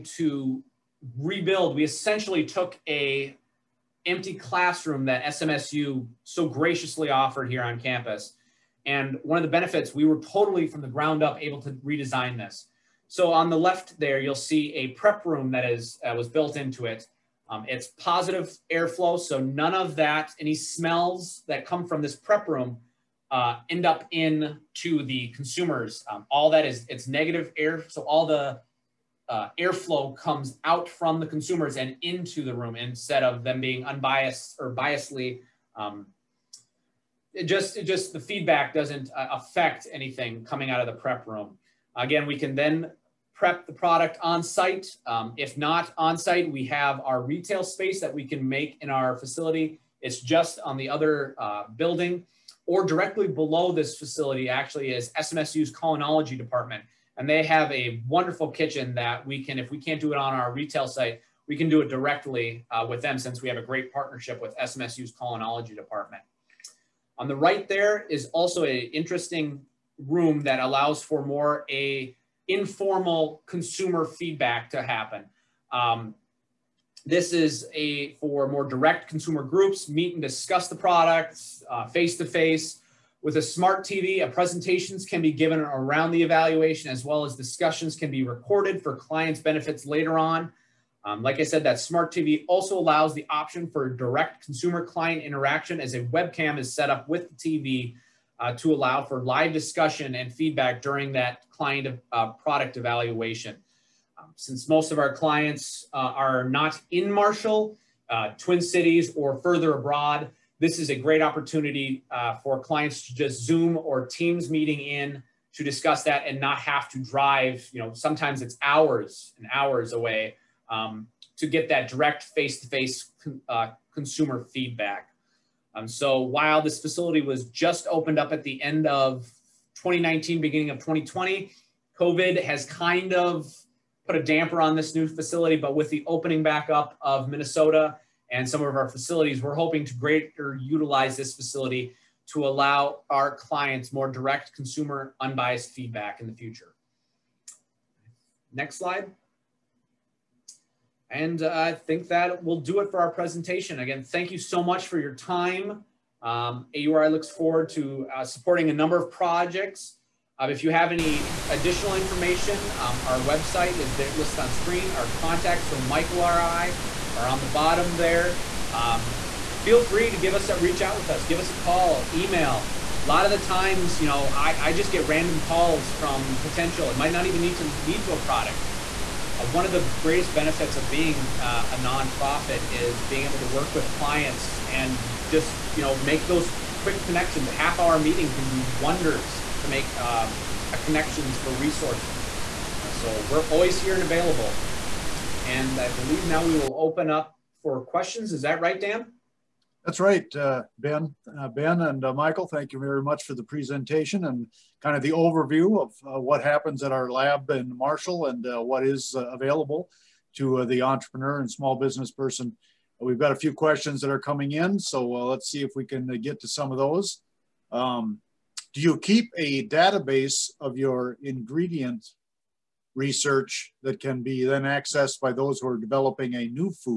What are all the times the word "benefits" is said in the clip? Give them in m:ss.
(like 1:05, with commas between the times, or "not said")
0:09, 1:29, 3:00.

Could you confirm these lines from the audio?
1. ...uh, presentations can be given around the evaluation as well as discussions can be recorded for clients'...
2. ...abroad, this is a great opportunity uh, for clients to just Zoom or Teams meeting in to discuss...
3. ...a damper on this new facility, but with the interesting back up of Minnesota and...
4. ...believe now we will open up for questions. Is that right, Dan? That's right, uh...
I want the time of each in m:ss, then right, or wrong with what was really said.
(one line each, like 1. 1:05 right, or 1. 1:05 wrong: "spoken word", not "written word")
1. 1:24 right
2. 1:49 right
3. 2:14 wrong: "opening", not "interesting"
4. 3:15 right.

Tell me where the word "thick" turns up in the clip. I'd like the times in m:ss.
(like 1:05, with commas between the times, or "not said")
not said.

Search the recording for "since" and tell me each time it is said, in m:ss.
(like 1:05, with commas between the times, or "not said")
1:03, 1:44.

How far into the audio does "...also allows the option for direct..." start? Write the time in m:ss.
1:32.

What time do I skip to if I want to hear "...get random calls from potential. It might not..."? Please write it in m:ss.
2:54.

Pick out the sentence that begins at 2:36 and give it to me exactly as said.
Um, AURI looks forward to uh, supporting a number of projects.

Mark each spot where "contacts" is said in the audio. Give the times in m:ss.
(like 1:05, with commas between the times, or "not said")
2:45.